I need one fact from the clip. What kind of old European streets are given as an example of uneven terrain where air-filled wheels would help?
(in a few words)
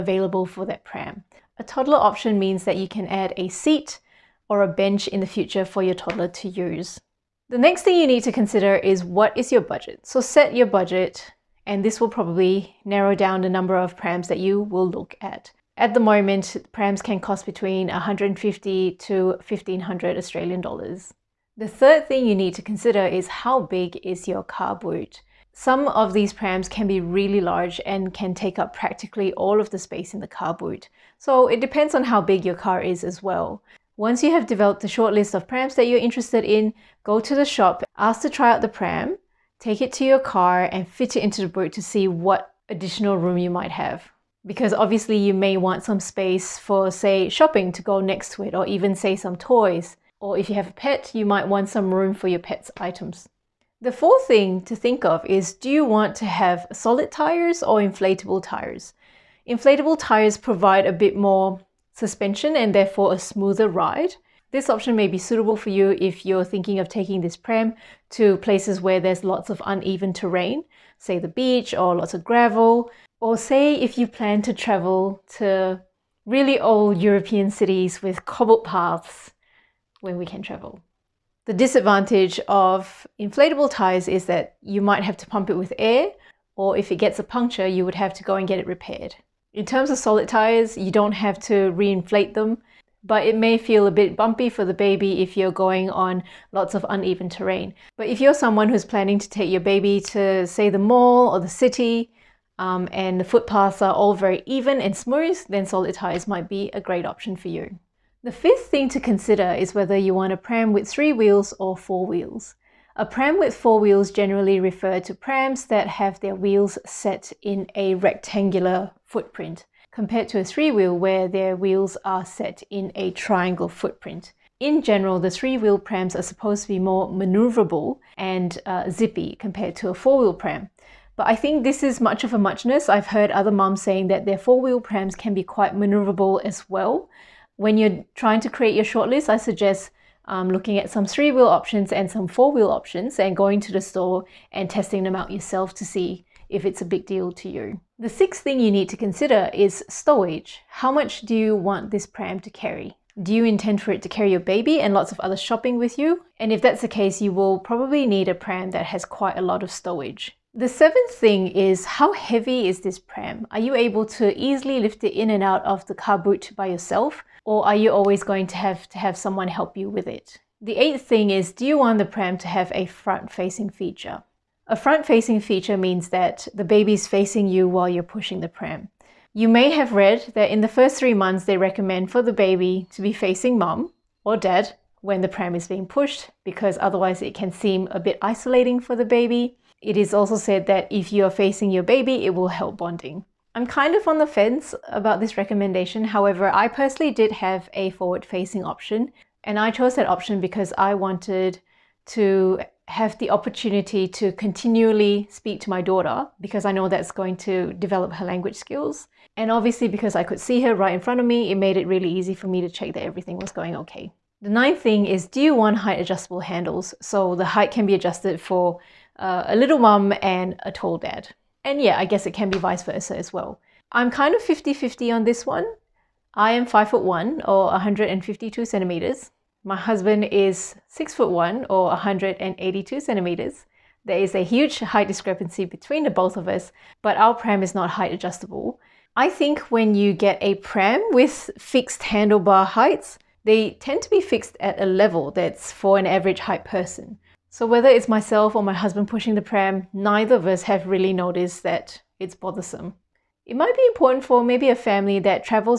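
cobbled paths.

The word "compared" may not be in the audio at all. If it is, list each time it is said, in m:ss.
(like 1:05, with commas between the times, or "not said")
1:59, 2:09.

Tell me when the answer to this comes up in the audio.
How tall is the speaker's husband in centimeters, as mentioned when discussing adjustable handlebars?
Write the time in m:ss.
3:51.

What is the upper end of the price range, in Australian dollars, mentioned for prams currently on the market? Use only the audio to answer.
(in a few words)
1500.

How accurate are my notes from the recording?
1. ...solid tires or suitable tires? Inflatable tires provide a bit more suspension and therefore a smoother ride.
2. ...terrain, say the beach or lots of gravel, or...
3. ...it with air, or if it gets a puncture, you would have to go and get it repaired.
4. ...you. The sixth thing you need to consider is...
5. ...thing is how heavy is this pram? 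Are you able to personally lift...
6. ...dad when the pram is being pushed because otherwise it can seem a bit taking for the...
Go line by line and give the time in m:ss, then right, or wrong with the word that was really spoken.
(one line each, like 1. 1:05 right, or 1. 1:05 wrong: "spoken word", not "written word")
1. 0:56 wrong: "inflatable", not "suitable"
2. 1:10 right
3. 1:25 right
4. 2:27 right
5. 2:41 wrong: "easily", not "personally"
6. 3:04 wrong: "isolating", not "taking".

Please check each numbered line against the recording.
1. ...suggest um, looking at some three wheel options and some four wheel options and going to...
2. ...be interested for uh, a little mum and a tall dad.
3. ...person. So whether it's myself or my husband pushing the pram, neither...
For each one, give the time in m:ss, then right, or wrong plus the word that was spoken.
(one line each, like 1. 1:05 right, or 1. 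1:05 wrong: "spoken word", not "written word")
1. 2:19 right
2. 3:37 wrong: "adjusted", not "interested"
3. 4:06 right.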